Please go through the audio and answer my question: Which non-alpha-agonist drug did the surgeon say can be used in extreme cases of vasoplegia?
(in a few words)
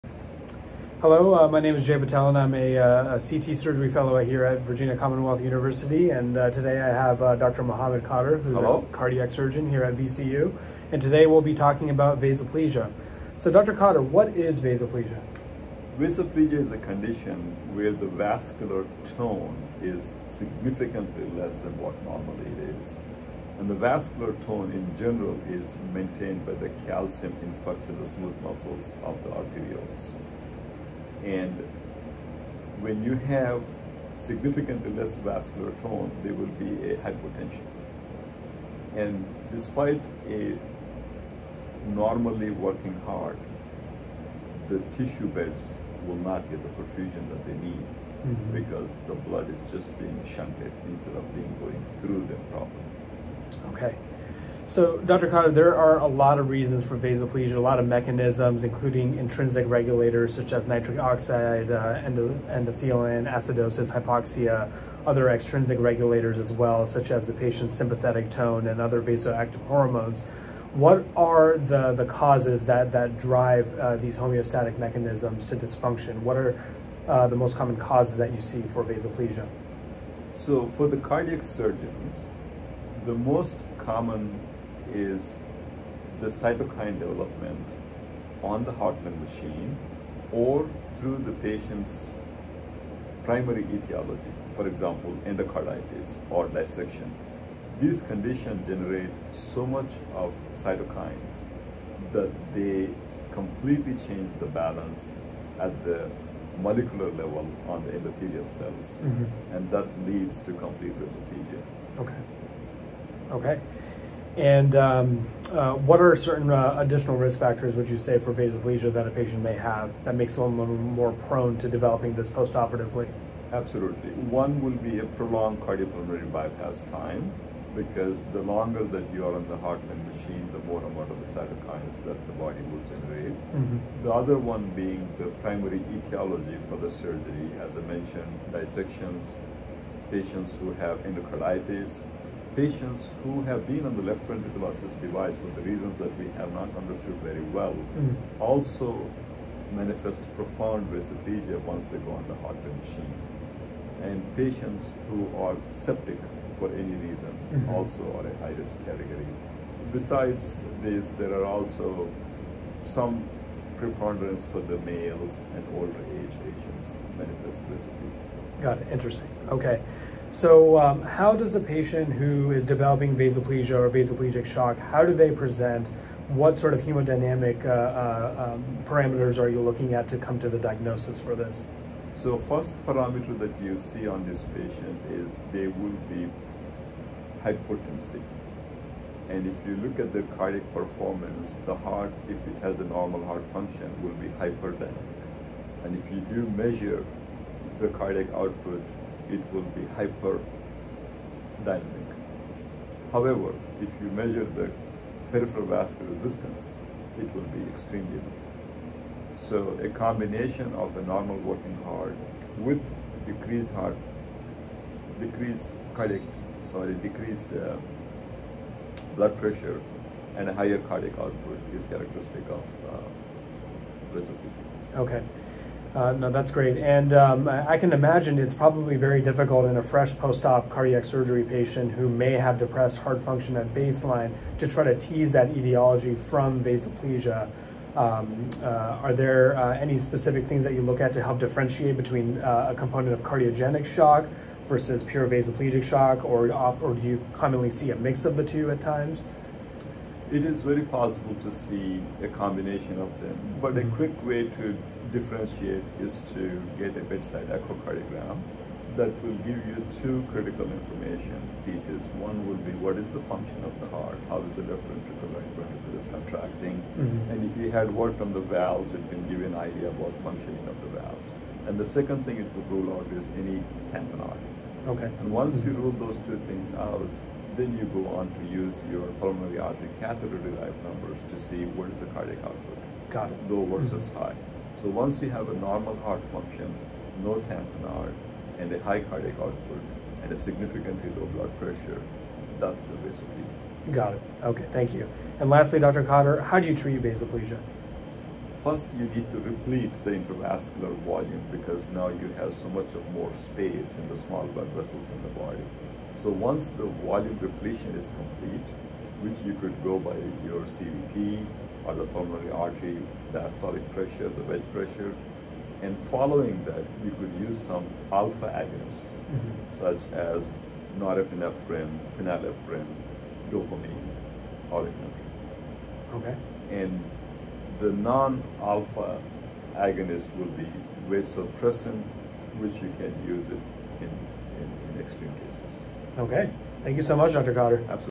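Vasopressin.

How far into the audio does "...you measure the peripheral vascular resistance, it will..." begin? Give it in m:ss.
3:24.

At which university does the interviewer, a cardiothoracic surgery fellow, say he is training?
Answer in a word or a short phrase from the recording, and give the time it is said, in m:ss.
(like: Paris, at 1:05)
Virginia Commonwealth University, at 0:04.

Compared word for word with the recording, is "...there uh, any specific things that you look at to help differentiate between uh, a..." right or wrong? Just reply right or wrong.
right.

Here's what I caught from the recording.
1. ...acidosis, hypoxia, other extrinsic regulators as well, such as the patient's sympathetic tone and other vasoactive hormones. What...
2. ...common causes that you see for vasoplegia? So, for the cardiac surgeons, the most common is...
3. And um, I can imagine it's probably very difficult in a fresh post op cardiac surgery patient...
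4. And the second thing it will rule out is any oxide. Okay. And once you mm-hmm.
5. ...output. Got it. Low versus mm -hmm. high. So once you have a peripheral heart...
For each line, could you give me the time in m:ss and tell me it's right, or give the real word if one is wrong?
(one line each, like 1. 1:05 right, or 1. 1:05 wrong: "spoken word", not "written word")
1. 1:03 right
2. 1:17 right
3. 3:46 right
4. 4:31 wrong: "tamponade", not "oxide"
5. 4:42 wrong: "normal", not "peripheral".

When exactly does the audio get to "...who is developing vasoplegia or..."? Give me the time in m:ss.
2:52.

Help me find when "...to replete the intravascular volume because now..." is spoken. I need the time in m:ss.
4:59.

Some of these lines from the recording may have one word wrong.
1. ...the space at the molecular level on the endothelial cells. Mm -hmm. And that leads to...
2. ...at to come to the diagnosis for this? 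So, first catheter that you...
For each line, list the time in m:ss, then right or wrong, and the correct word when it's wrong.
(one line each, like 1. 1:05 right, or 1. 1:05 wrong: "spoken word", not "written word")
1. 1:44 wrong: "balance", not "space"
2. 2:59 wrong: "parameter", not "catheter".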